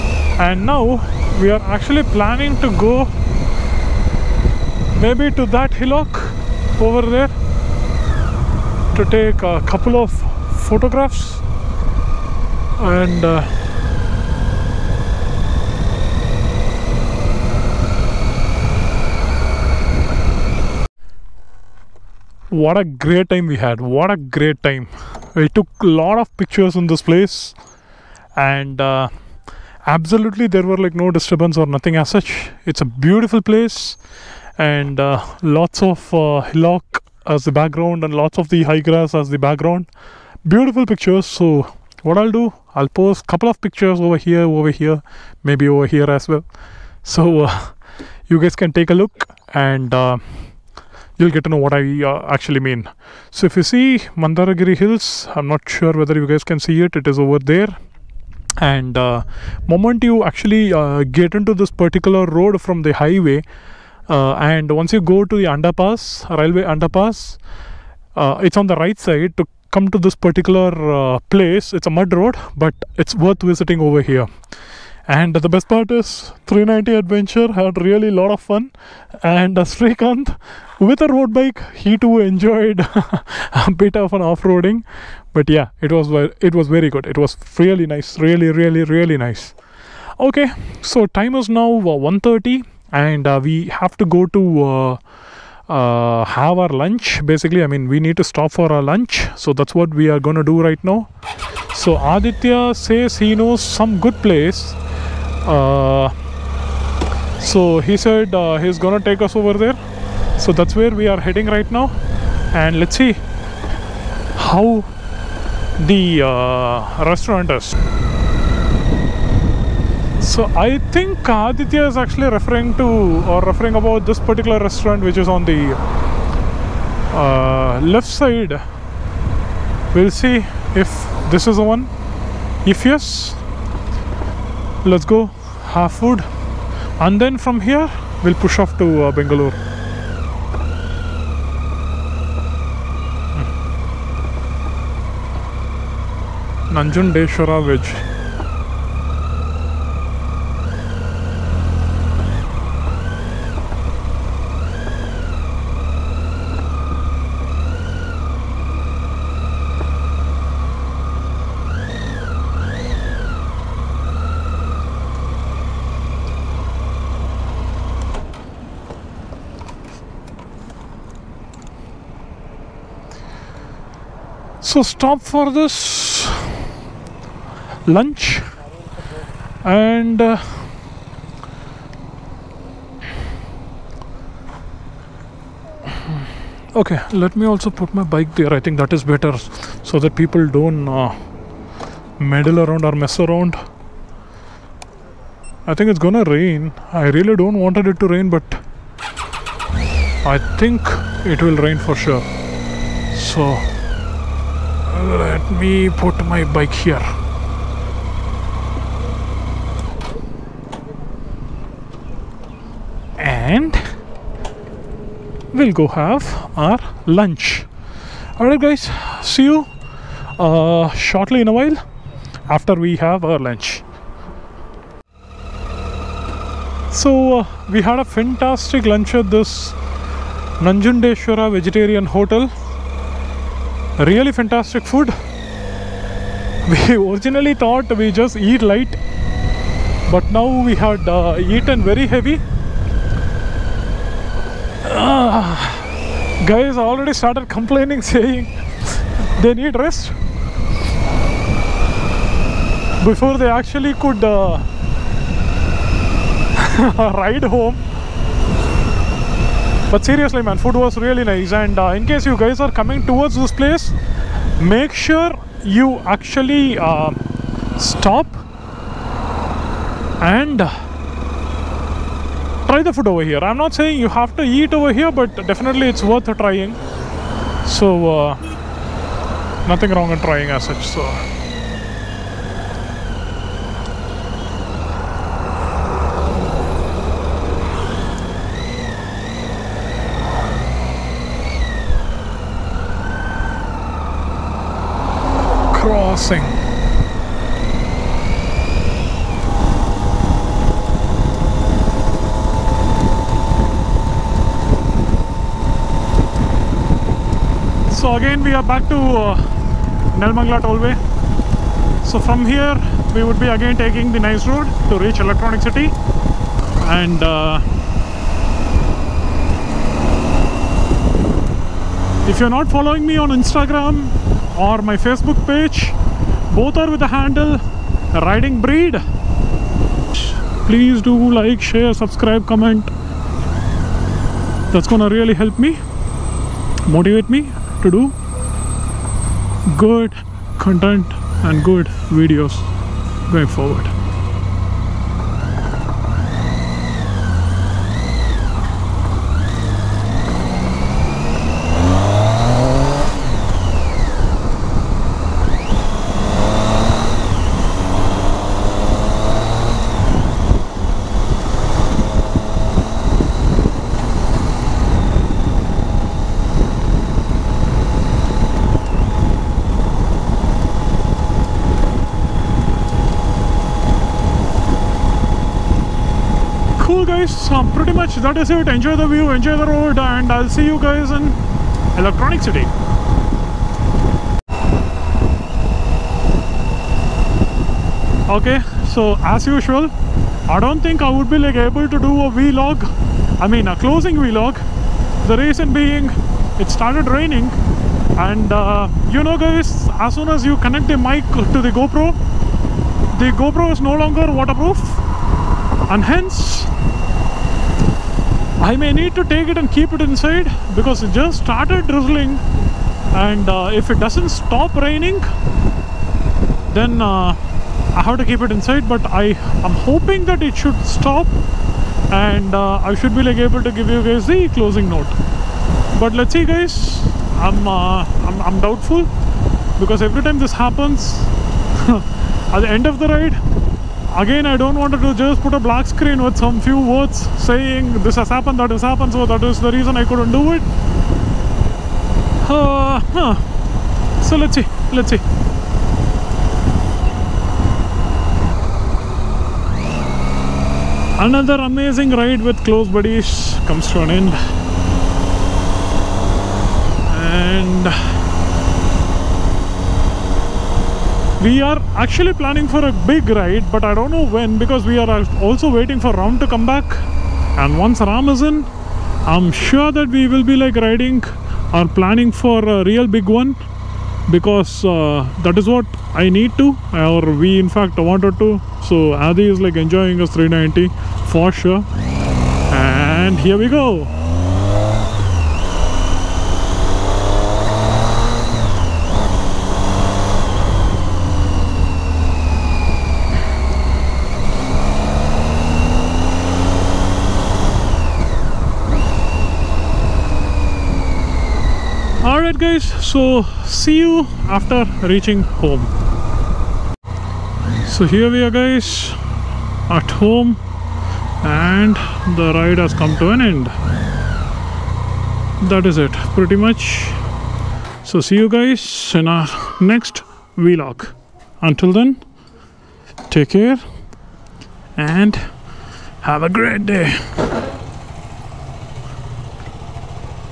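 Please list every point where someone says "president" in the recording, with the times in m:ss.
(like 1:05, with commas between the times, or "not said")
not said.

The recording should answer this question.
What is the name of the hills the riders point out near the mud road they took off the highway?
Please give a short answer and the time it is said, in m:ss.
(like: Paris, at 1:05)
Mandaragiri Hills, at 0:54.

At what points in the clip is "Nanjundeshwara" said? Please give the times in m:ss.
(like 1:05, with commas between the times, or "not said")
2:26, 3:50.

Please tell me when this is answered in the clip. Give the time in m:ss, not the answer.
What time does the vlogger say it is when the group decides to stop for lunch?
1:31.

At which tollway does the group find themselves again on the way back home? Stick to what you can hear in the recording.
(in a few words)
Nelmangla Tollway.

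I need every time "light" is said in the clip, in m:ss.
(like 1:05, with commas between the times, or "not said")
3:58.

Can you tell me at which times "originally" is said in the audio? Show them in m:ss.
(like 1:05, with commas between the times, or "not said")
3:56.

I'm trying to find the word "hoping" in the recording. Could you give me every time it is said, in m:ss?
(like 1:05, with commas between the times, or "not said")
6:59.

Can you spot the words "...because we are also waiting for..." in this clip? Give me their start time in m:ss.
7:44.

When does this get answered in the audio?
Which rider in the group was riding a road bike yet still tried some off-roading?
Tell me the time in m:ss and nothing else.
1:19.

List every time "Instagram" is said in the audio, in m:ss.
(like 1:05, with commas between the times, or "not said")
5:23.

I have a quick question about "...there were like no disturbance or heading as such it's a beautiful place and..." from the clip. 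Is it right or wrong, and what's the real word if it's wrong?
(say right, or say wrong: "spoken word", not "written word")
wrong: "nothing", not "heading".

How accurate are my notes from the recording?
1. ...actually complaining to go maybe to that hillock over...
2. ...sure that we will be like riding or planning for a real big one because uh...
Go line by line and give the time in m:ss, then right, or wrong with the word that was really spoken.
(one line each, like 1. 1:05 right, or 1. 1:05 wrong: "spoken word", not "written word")
1. 0:01 wrong: "planning", not "complaining"
2. 7:49 right.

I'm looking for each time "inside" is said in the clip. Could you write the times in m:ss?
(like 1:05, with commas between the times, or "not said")
6:50, 6:58.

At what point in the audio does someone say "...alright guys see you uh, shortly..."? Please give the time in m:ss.
3:38.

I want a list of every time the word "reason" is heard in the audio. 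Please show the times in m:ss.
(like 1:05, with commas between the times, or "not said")
6:35, 7:19.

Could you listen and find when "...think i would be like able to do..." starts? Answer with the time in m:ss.
6:30.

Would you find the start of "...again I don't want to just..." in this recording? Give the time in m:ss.
7:14.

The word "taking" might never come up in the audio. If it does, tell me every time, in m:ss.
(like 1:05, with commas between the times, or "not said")
5:13.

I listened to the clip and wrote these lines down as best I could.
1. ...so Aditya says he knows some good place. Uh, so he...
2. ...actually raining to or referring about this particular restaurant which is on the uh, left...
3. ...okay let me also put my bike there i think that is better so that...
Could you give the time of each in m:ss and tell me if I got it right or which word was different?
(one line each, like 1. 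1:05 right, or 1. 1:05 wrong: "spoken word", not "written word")
1. 1:41 right
2. 2:01 wrong: "referring", not "raining"
3. 3:06 right.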